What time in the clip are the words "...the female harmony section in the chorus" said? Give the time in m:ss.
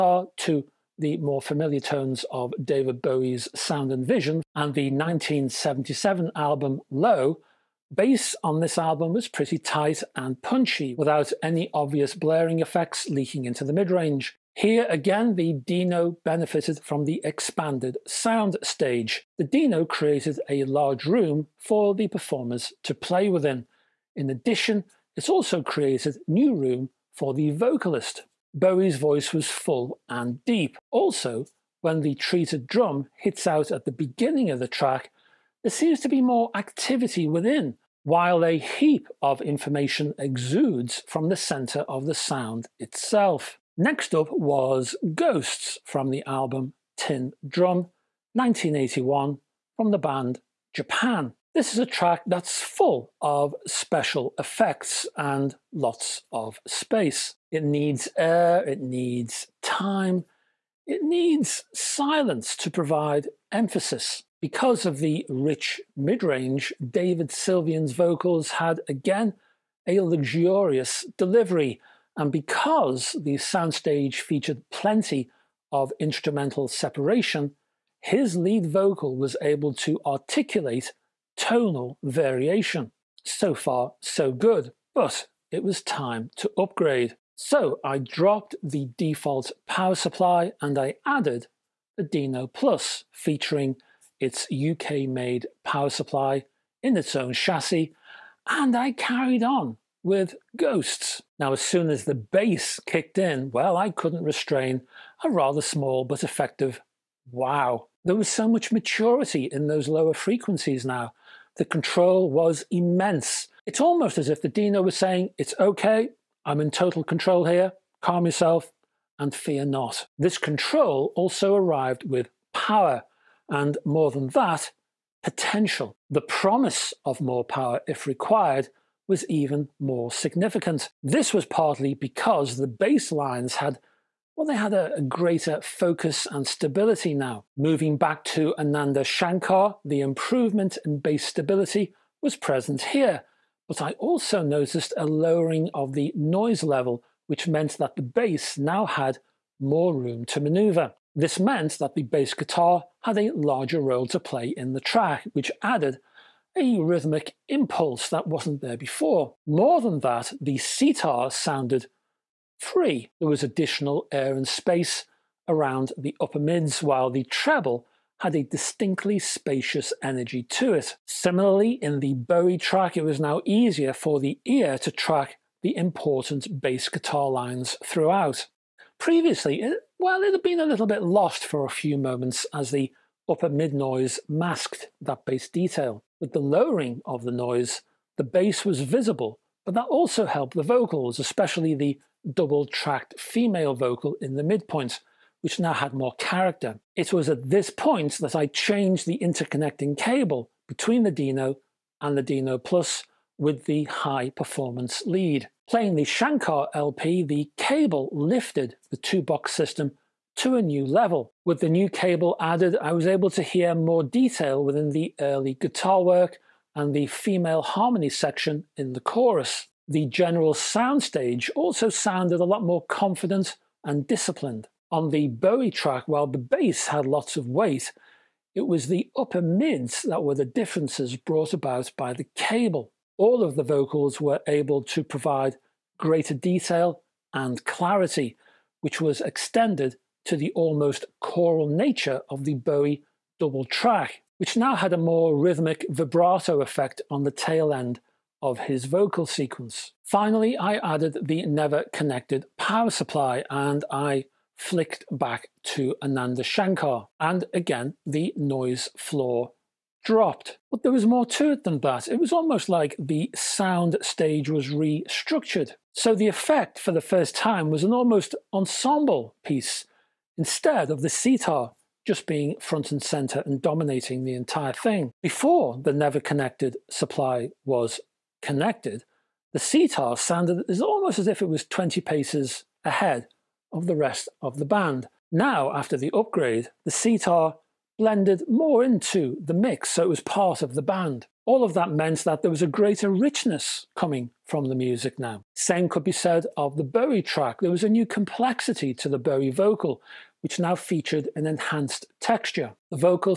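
3:36.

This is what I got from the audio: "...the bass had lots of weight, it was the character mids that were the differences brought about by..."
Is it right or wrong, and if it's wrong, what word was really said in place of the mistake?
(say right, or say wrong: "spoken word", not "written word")
wrong: "upper", not "character".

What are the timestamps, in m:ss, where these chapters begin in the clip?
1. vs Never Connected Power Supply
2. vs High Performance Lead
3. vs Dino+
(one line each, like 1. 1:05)
1. 4:09
2. 3:16
3. 1:22.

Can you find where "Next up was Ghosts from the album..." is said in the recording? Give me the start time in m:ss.
0:43.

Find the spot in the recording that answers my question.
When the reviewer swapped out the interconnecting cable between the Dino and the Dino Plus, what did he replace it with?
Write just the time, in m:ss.
3:23.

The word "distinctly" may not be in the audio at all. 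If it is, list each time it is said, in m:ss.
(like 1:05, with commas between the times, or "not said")
2:48.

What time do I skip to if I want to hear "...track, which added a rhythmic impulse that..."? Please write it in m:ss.
2:34.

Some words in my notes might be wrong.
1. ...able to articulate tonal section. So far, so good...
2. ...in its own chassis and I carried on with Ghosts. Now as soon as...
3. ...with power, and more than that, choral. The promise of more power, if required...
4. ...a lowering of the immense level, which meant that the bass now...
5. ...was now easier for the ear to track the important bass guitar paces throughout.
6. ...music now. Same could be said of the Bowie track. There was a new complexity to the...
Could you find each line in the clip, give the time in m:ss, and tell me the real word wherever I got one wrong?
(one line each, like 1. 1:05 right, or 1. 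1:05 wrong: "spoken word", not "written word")
1. 1:19 wrong: "variation", not "section"
2. 1:36 right
3. 2:02 wrong: "potential", not "choral"
4. 2:24 wrong: "noise", not "immense"
5. 2:53 wrong: "lines", not "paces"
6. 4:54 right.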